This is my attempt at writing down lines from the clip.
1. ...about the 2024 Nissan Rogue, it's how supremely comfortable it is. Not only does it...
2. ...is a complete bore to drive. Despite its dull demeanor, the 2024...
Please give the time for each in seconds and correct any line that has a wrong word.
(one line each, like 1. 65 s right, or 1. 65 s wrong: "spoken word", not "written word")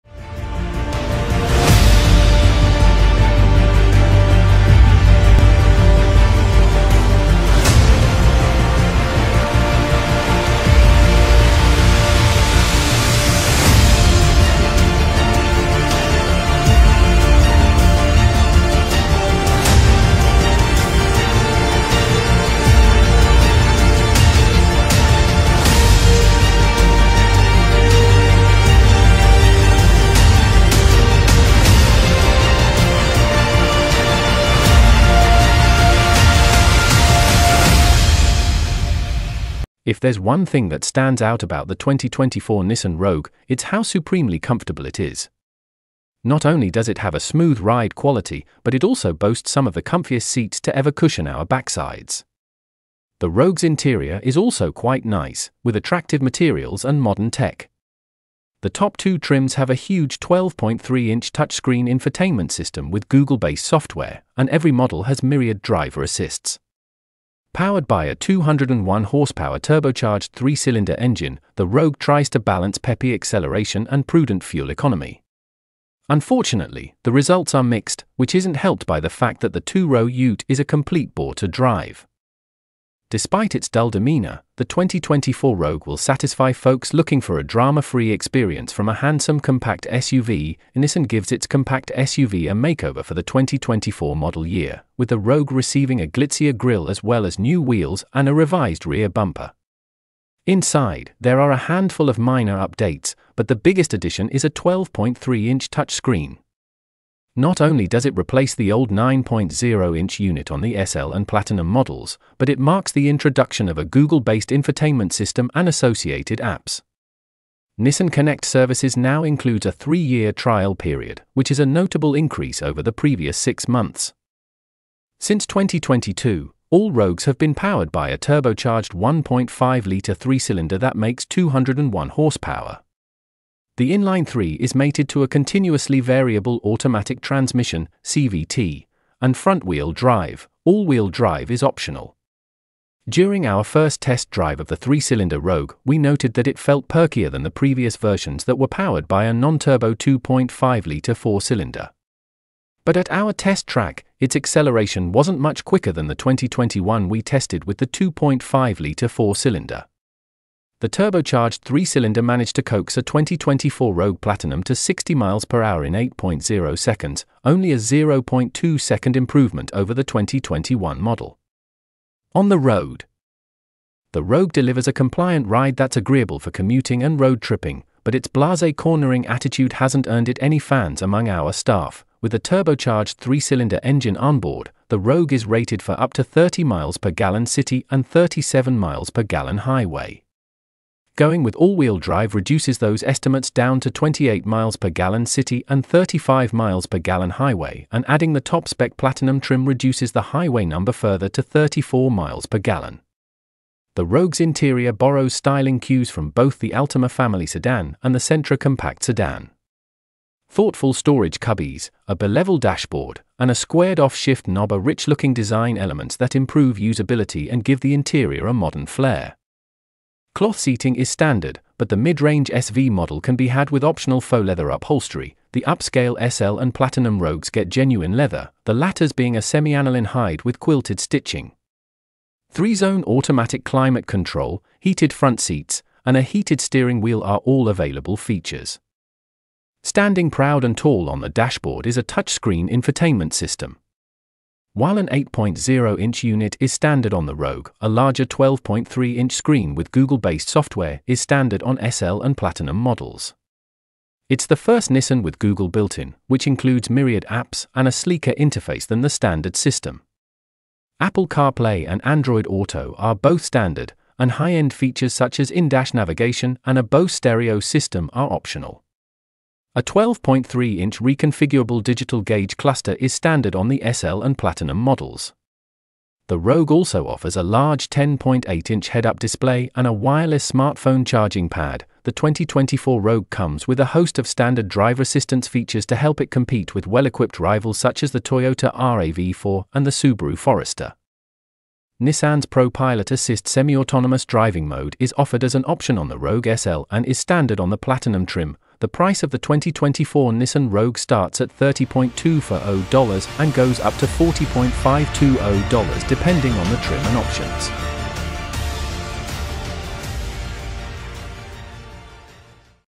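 1. 41 s right
2. 80 s right.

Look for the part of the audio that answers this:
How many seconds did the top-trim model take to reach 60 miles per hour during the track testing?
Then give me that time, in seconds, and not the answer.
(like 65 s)
165 s.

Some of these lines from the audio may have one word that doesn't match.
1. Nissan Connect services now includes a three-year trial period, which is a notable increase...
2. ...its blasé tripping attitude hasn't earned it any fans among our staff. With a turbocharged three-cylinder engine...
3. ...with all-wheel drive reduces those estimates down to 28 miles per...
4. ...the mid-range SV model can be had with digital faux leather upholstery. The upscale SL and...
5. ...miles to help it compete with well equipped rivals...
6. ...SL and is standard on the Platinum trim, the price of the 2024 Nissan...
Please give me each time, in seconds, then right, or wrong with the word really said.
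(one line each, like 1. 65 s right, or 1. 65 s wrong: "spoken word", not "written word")
1. 117 s right
2. 178 s wrong: "cornering", not "tripping"
3. 191 s right
4. 221 s wrong: "optional", not "digital"
5. 285 s wrong: "features", not "miles"
6. 296 s right.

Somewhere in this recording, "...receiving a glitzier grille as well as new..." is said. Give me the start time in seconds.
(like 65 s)
95 s.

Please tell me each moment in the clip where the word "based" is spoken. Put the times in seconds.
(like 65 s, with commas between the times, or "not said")
63 s, 113 s, 249 s.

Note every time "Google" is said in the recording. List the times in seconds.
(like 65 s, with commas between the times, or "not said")
63 s, 113 s, 249 s, 255 s.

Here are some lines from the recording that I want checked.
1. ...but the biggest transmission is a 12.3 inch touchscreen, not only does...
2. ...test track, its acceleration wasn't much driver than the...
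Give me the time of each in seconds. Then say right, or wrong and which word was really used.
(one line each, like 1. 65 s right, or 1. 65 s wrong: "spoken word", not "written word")
1. 103 s wrong: "addition", not "transmission"
2. 153 s wrong: "quicker", not "driver".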